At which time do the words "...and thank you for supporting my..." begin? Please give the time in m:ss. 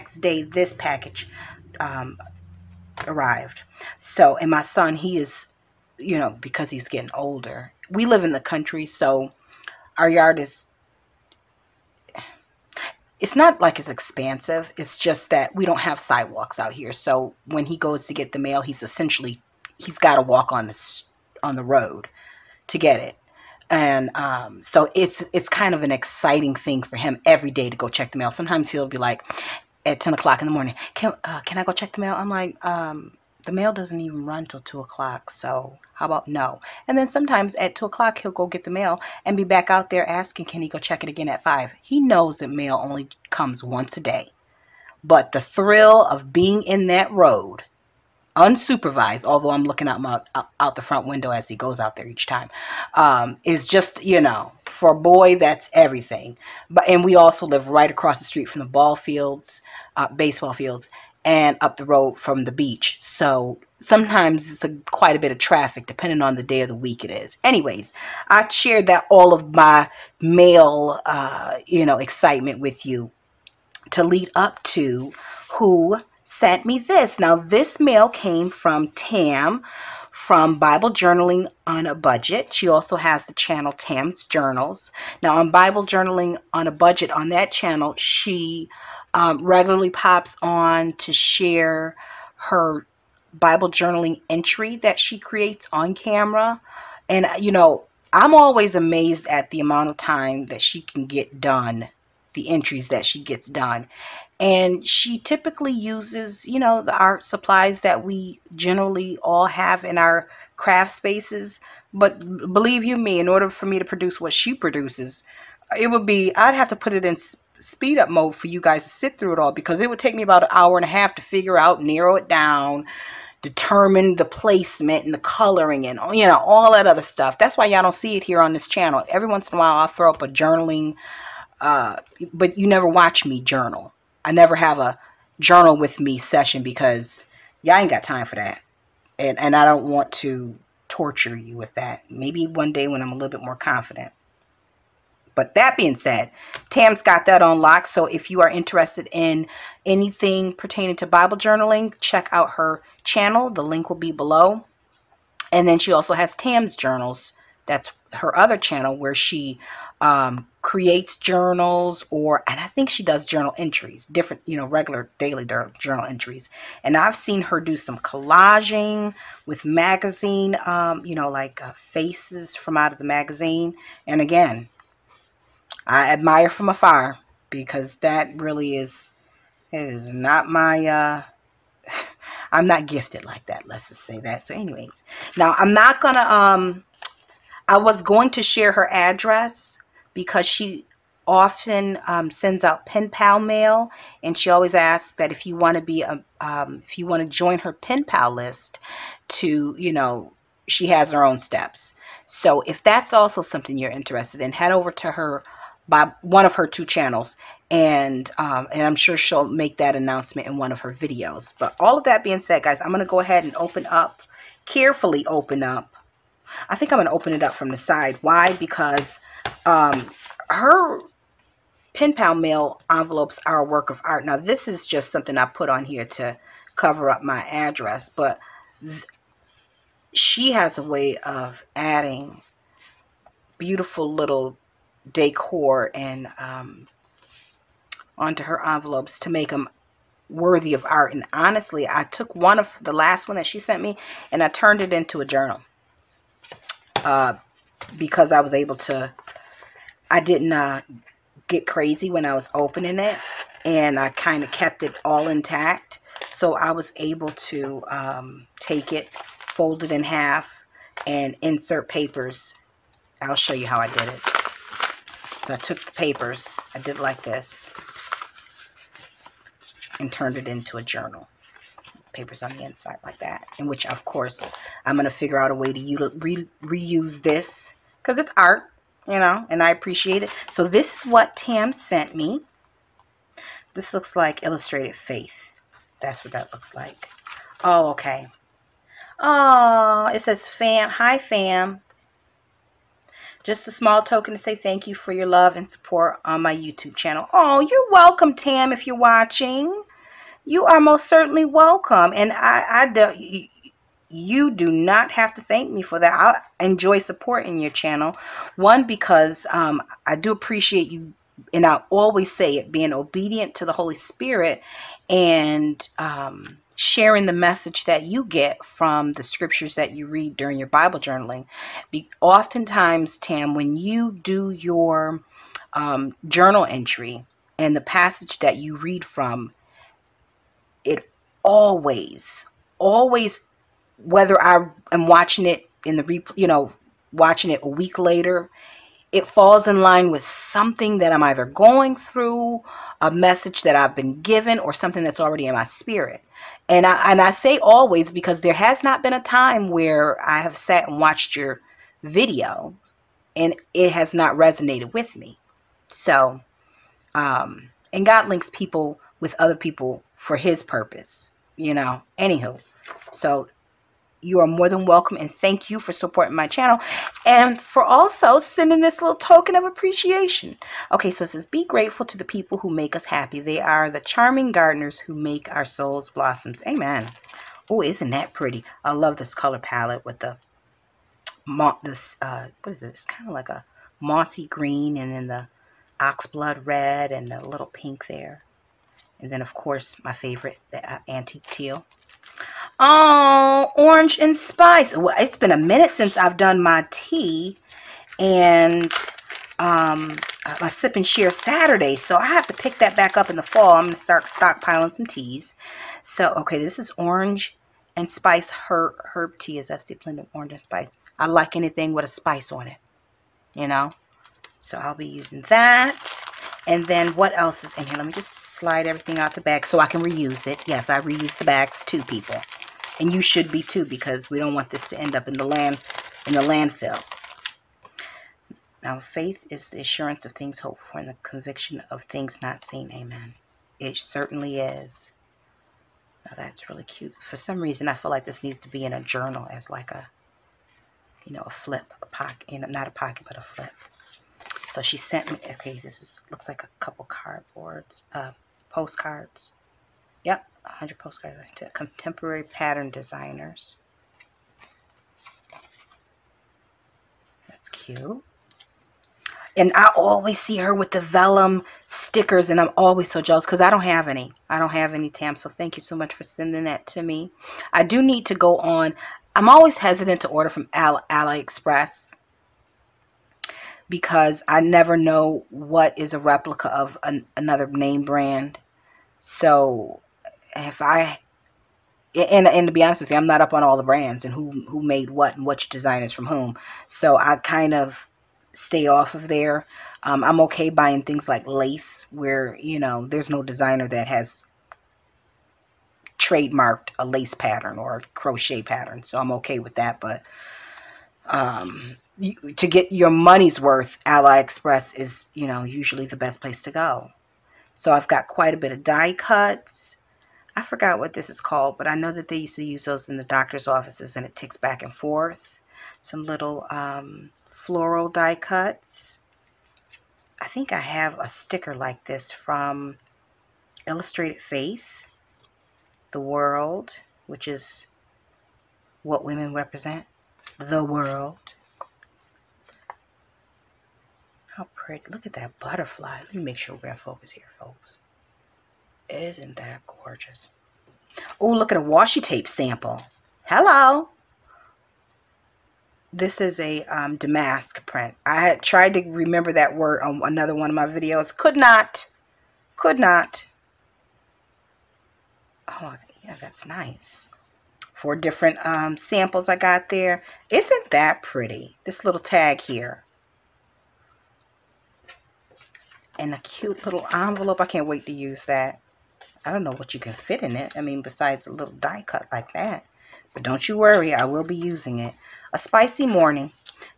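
6:05.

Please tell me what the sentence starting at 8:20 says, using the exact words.
But um, you, to get your money's worth, AliExpress is you know usually the best place to go.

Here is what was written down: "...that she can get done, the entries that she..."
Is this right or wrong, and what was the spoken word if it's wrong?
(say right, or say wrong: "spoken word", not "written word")
right.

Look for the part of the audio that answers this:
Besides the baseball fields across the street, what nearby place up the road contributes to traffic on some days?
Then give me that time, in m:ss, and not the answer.
1:02.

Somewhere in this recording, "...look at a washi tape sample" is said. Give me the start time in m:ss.
9:01.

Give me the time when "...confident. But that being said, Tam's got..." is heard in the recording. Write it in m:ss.
2:23.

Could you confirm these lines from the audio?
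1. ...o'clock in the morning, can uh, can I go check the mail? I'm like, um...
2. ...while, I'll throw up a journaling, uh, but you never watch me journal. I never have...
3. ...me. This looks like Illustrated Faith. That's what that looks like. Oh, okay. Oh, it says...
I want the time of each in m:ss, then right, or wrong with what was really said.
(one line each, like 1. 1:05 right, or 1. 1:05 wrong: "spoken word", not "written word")
1. 0:30 right
2. 2:09 right
3. 4:42 right.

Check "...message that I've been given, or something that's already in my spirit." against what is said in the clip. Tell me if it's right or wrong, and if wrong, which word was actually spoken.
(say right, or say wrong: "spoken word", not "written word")
right.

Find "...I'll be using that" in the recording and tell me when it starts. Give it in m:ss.
6:54.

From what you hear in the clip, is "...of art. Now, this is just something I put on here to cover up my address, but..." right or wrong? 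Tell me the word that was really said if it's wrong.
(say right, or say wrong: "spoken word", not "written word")
right.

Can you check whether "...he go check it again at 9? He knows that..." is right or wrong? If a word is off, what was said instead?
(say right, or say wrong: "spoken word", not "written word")
wrong: "5", not "9".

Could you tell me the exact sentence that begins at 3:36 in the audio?
I think I'm going to open it up from the side.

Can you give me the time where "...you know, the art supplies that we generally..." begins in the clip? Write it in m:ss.
1:46.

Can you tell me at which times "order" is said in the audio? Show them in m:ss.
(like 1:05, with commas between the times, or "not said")
1:53, 7:50.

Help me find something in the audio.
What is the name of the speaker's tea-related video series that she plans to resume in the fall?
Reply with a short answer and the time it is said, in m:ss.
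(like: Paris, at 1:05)
Sip and Share Saturday, at 6:40.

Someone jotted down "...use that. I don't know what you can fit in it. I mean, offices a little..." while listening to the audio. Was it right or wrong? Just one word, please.
wrong.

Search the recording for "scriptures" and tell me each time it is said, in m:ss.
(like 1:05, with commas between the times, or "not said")
5:19.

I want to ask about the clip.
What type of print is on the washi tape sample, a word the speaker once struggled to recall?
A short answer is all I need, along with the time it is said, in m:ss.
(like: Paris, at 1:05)
damask, at 9:07.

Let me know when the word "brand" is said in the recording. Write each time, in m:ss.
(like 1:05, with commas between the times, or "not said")
7:58, 8:03.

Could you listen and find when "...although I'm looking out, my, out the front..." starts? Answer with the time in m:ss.
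0:49.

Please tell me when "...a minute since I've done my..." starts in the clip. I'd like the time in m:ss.
6:35.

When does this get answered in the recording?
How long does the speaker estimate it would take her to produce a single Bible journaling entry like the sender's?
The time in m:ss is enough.
2:00.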